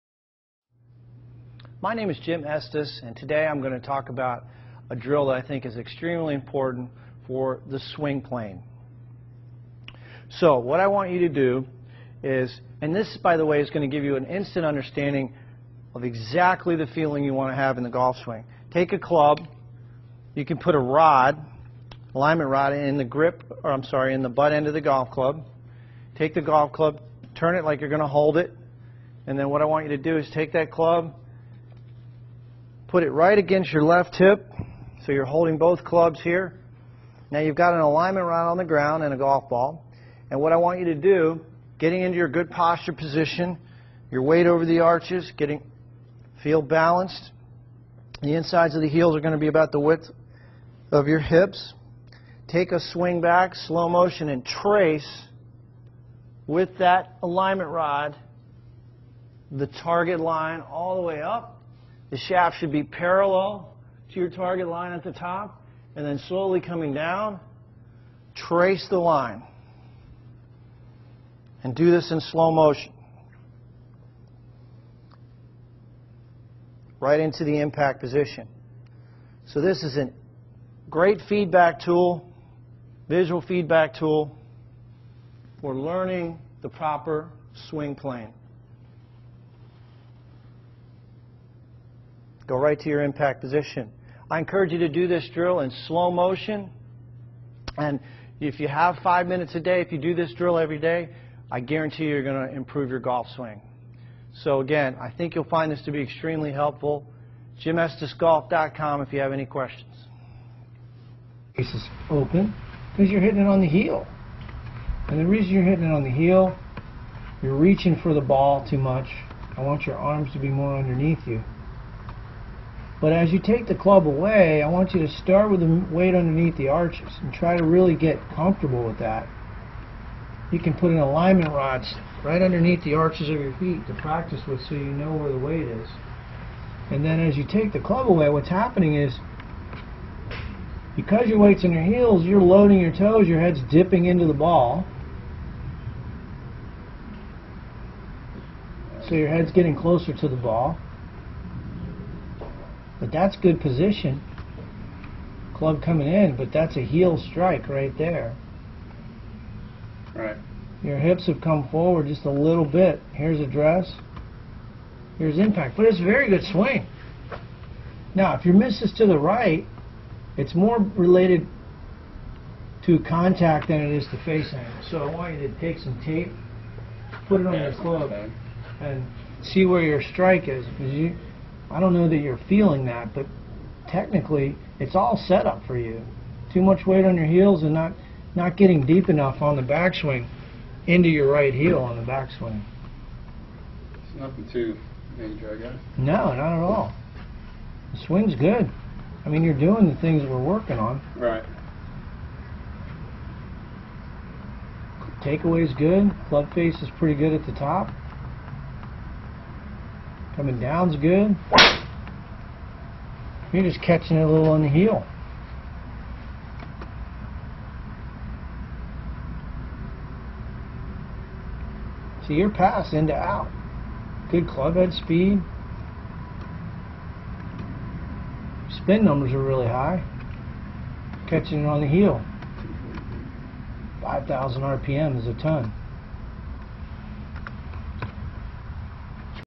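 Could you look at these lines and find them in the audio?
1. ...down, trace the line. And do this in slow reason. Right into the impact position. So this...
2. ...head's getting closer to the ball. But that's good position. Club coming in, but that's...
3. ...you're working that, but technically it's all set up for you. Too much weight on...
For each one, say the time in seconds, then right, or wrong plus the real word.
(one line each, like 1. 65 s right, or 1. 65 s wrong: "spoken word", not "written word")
1. 66 s wrong: "motion", not "reason"
2. 149 s right
3. 182 s wrong: "feeling", not "working".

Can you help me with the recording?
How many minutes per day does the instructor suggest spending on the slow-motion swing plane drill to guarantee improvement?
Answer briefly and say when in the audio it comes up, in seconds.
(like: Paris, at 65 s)
5, at 99 s.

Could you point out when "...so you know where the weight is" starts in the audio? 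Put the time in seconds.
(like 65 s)
134 s.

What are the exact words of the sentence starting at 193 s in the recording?
It's nothing too major, I guess.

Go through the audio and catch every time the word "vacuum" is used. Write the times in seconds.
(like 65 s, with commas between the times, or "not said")
not said.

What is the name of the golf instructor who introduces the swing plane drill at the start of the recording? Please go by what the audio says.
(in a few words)
Jim Estes.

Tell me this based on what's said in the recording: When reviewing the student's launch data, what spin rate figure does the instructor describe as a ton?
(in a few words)
5,000 RPM.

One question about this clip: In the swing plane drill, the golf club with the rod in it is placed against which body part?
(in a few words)
left hip.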